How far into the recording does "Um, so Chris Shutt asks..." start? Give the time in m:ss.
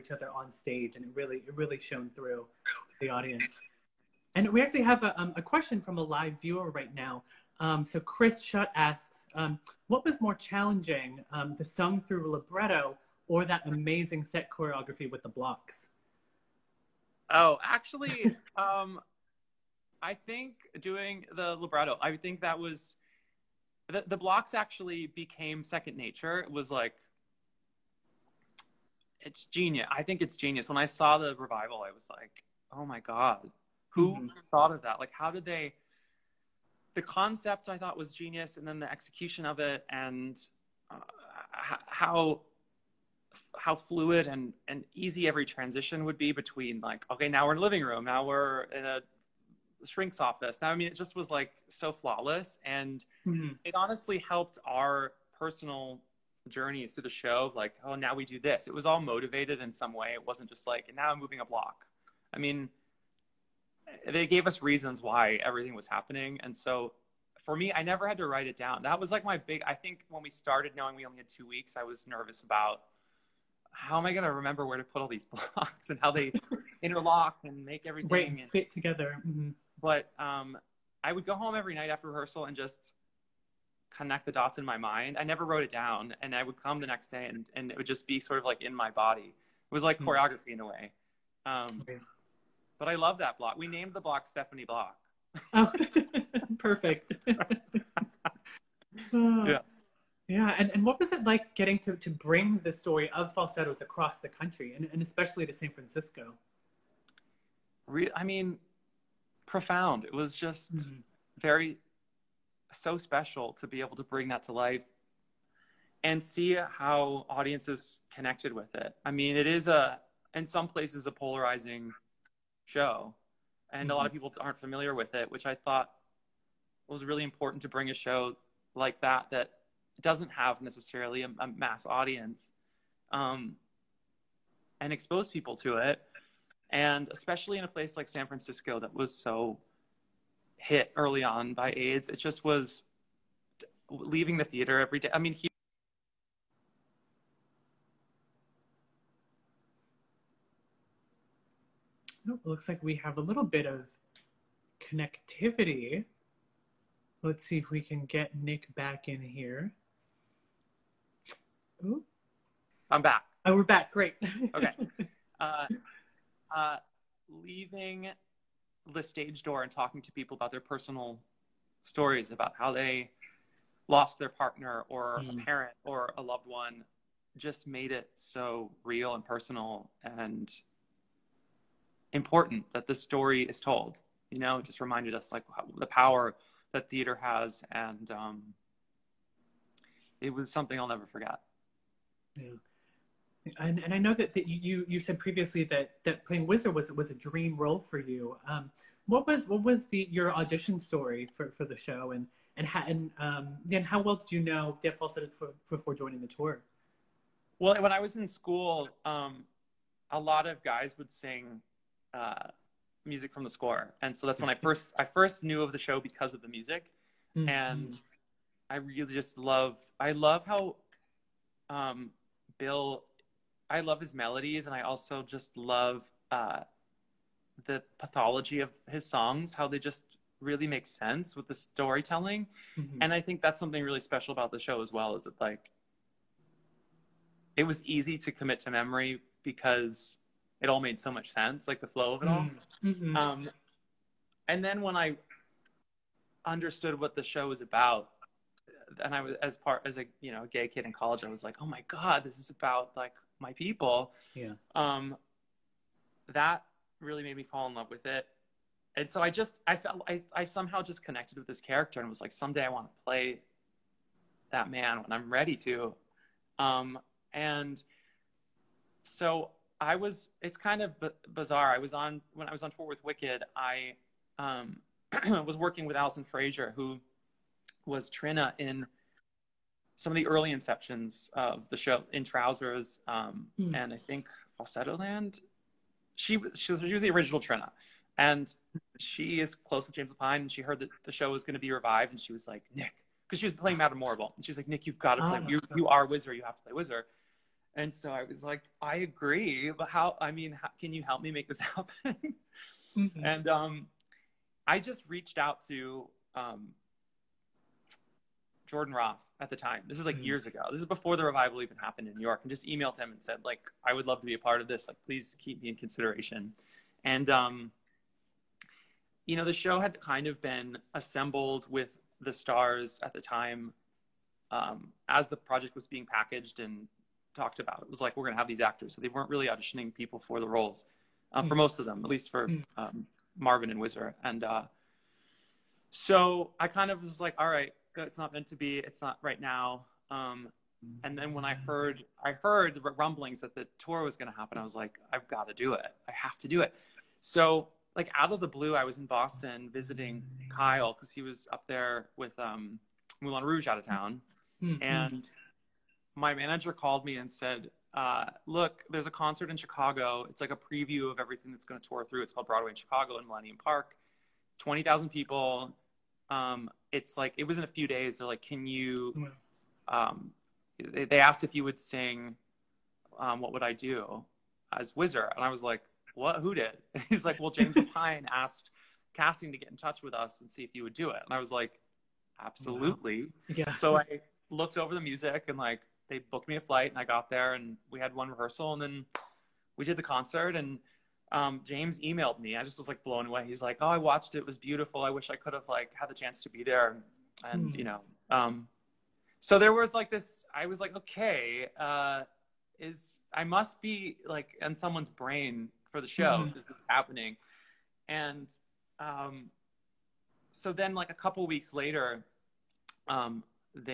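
0:07.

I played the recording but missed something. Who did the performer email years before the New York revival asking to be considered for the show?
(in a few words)
Jordan Roth.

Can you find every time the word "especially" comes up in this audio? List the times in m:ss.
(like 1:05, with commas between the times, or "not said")
1:45, 2:17.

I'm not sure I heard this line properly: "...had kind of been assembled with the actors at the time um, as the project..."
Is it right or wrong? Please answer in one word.
wrong.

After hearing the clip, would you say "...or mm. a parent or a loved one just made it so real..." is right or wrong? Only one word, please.
right.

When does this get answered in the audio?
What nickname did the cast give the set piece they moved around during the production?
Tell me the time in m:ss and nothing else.
1:34.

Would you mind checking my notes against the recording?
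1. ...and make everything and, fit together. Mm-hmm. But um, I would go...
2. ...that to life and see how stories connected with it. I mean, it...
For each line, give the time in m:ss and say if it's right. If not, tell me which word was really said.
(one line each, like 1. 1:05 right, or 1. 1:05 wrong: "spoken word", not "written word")
1. 1:17 right
2. 1:54 wrong: "audiences", not "stories".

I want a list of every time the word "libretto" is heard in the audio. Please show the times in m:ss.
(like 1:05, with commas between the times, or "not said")
0:12, 0:21.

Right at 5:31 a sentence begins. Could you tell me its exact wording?
most of them, at least for mm.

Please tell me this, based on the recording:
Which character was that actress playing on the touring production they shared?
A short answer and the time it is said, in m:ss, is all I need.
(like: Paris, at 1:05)
Madame Morrible, at 4:53.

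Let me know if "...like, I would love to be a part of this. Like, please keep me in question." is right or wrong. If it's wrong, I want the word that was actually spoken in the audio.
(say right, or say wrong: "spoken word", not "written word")
wrong: "consideration", not "question".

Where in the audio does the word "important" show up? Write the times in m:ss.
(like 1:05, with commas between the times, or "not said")
2:07, 3:02.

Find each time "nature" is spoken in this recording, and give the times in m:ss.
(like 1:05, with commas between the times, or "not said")
0:25.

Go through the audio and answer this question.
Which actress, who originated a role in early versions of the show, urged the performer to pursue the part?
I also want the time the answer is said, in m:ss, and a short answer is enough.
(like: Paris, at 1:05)
Alison Fraser, at 4:35.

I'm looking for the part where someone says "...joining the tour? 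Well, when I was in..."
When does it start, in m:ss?
3:25.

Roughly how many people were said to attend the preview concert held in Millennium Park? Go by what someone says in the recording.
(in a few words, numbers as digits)
20,000.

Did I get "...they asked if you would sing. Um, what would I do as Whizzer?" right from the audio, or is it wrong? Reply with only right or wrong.
right.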